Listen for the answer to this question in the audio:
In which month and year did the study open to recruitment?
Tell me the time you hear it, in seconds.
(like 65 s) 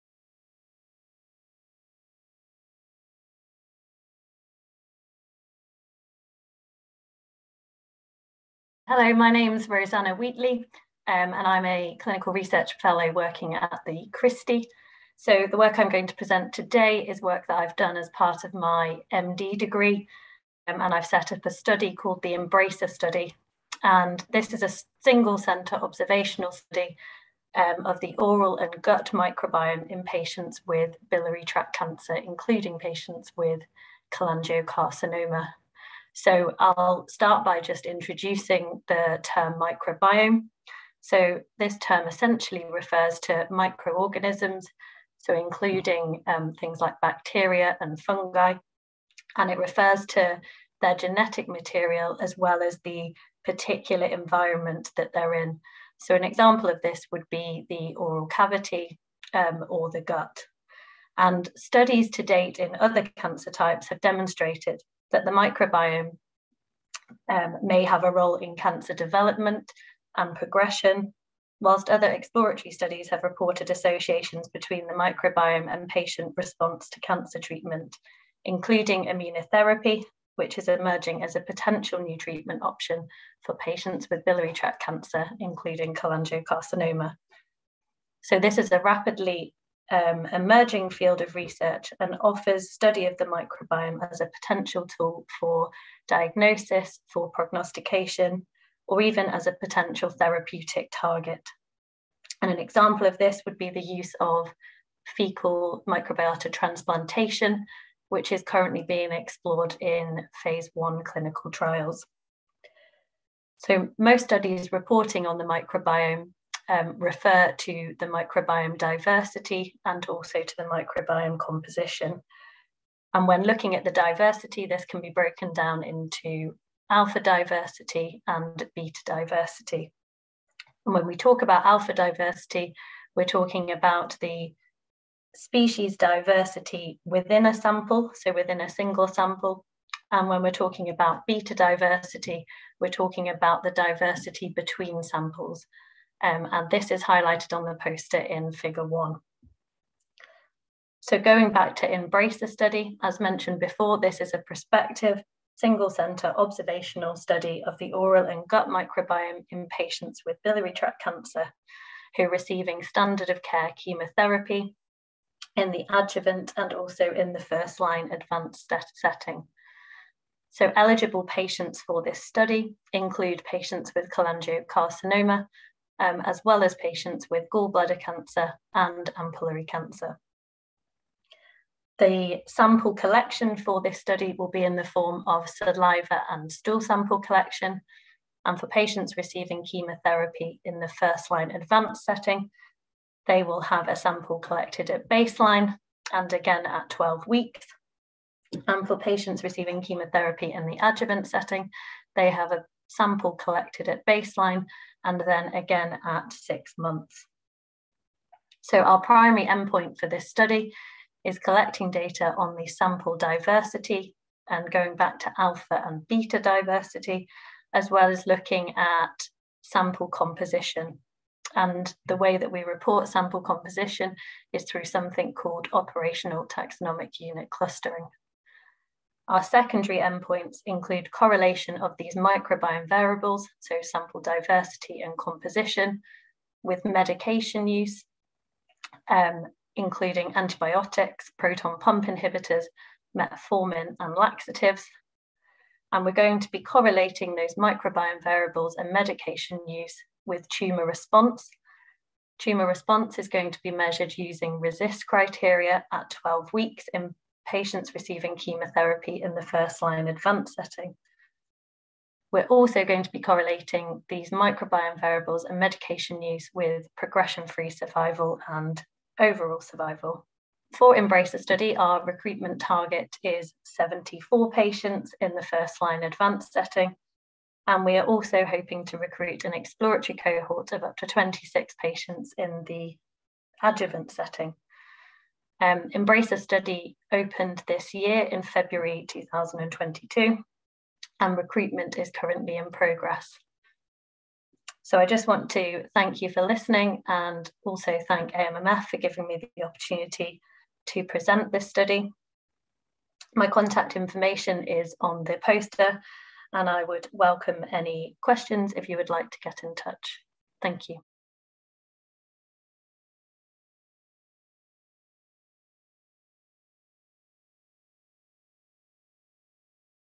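288 s.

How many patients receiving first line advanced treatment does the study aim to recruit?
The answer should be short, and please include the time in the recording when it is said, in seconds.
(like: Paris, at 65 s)
74, at 273 s.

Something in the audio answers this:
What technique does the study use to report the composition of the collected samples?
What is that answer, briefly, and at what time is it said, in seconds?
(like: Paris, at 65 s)
operational taxonomic unit clustering, at 225 s.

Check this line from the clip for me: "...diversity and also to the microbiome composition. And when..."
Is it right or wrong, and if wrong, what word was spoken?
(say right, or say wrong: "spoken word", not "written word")
right.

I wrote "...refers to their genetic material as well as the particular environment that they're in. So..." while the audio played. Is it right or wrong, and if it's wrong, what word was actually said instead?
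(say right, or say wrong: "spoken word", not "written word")
right.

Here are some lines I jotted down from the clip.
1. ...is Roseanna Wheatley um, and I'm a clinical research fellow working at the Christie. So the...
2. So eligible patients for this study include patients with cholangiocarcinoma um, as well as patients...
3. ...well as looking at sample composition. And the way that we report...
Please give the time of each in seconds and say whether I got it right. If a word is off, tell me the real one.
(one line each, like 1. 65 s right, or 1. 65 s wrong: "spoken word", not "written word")
1. 9 s right
2. 170 s right
3. 217 s right.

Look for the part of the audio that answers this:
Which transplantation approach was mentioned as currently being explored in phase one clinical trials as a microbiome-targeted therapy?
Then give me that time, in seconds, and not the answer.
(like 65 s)
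105 s.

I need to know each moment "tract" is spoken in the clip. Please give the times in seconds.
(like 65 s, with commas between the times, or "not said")
31 s, 84 s, 160 s.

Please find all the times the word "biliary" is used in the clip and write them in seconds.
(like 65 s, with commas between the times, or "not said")
31 s, 84 s, 160 s.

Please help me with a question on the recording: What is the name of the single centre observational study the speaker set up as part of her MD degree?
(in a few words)
Embracer Study.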